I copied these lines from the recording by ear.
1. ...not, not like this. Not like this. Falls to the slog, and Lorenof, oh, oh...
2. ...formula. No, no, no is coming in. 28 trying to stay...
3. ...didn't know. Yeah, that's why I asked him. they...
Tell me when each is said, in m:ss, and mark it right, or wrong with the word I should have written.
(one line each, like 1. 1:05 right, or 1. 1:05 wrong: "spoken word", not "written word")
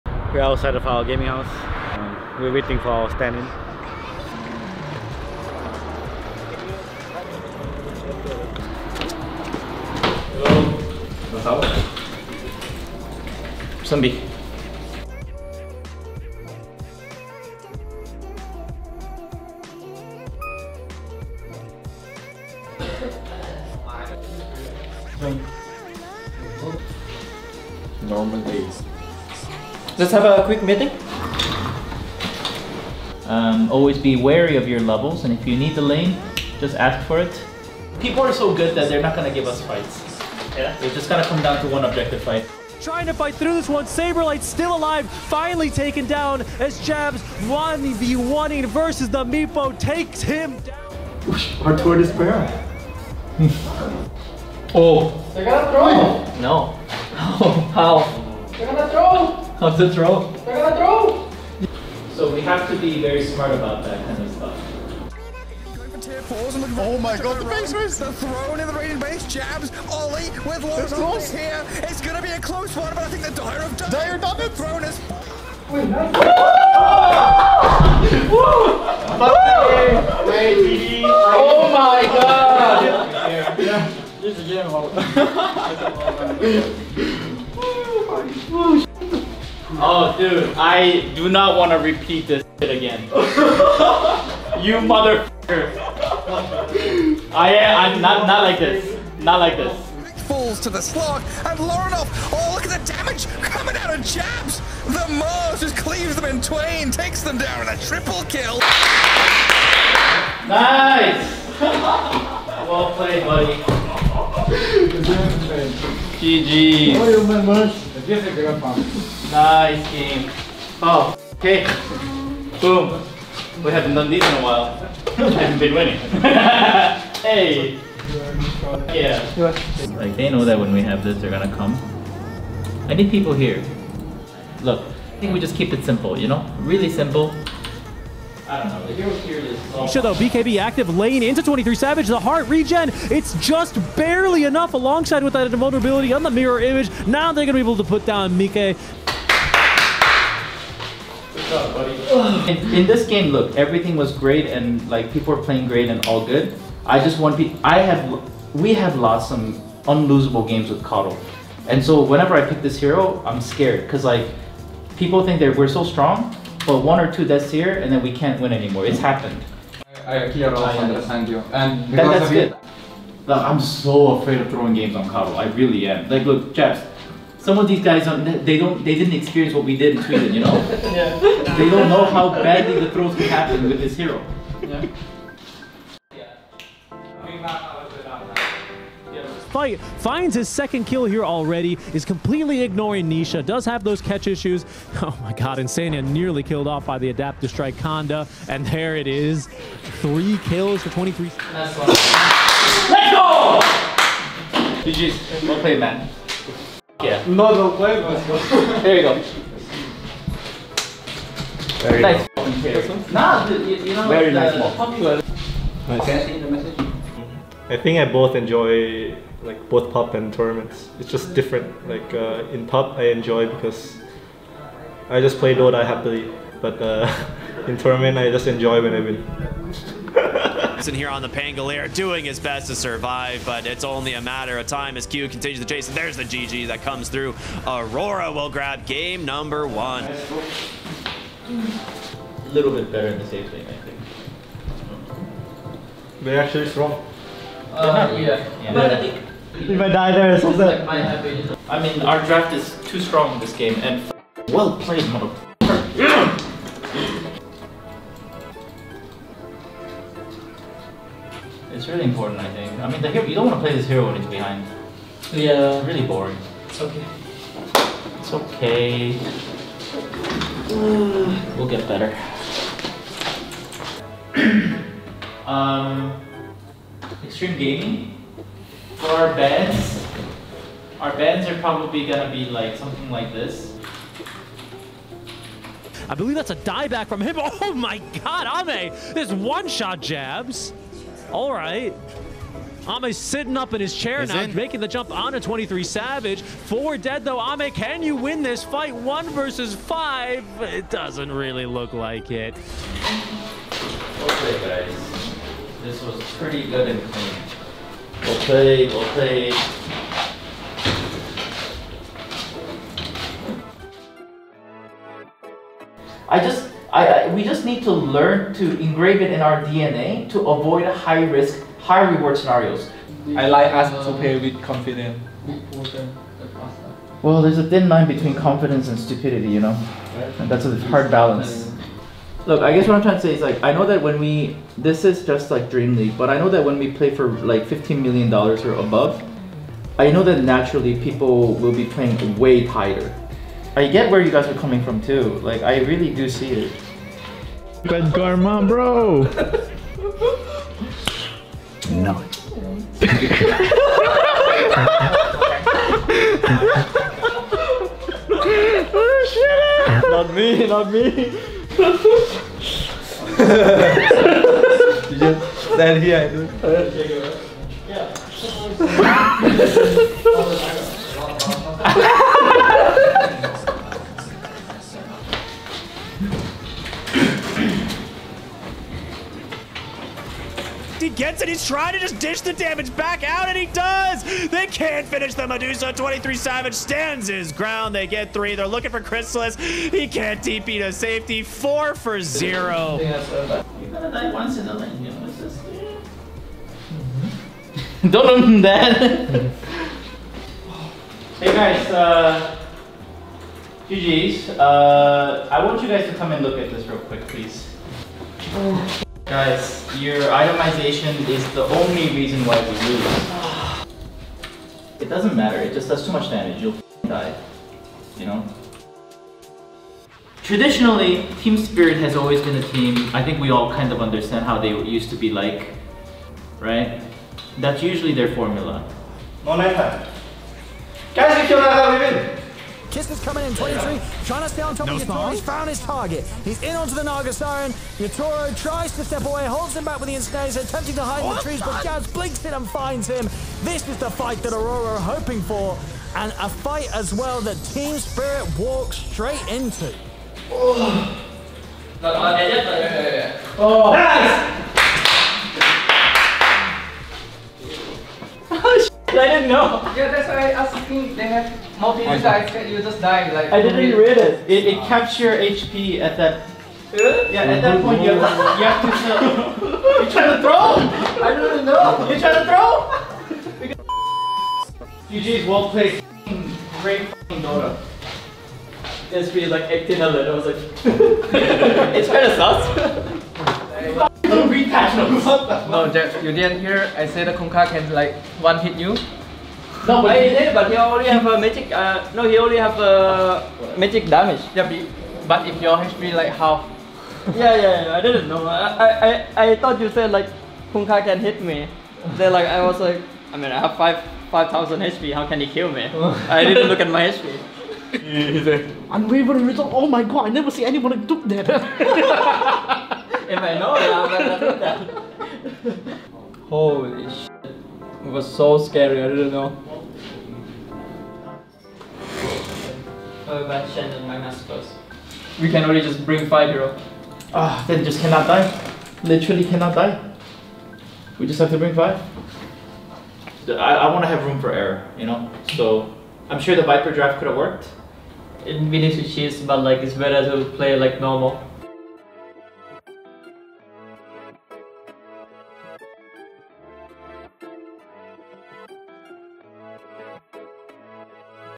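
1. 1:38 right
2. 7:08 wrong: "23", not "28"
3. 7:39 right.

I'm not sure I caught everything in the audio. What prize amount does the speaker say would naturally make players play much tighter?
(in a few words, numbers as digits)
15 million dollars.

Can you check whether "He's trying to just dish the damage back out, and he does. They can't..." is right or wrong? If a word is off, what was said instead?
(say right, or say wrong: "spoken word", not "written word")
right.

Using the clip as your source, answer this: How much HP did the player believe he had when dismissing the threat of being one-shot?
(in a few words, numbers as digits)
5000.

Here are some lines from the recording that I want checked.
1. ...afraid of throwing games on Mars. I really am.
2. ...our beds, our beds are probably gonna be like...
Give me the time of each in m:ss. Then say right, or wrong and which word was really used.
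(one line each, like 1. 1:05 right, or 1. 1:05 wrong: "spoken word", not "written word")
1. 2:54 wrong: "Cabo", not "Mars"
2. 4:39 right.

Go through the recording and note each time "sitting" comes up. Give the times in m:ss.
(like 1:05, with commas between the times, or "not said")
4:53.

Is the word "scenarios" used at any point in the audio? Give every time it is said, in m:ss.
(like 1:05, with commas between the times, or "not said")
5:22.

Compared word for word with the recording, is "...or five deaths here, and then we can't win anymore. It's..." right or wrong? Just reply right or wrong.
wrong.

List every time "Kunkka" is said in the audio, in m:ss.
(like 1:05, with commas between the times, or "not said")
8:07, 8:20.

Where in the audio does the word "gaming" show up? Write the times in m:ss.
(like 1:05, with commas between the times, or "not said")
0:01, 4:37.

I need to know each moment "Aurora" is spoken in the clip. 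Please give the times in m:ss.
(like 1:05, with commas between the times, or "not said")
3:57, 7:24.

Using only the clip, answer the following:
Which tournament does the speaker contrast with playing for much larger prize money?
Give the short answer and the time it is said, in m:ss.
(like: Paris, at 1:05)
DreamLeague, at 5:35.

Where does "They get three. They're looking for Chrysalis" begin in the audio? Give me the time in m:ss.
6:27.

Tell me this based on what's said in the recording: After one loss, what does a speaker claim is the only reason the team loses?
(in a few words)
Itemization.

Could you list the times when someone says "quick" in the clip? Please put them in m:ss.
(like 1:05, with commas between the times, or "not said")
0:30, 6:46.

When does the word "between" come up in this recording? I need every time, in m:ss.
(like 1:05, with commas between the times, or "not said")
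5:28.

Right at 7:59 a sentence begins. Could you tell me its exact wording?
Just be like acting a little.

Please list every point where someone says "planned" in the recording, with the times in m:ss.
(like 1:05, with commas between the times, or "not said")
not said.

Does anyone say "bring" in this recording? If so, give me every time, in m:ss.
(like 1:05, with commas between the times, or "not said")
8:46, 8:51.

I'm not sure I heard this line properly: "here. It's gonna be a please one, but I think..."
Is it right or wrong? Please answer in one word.
wrong.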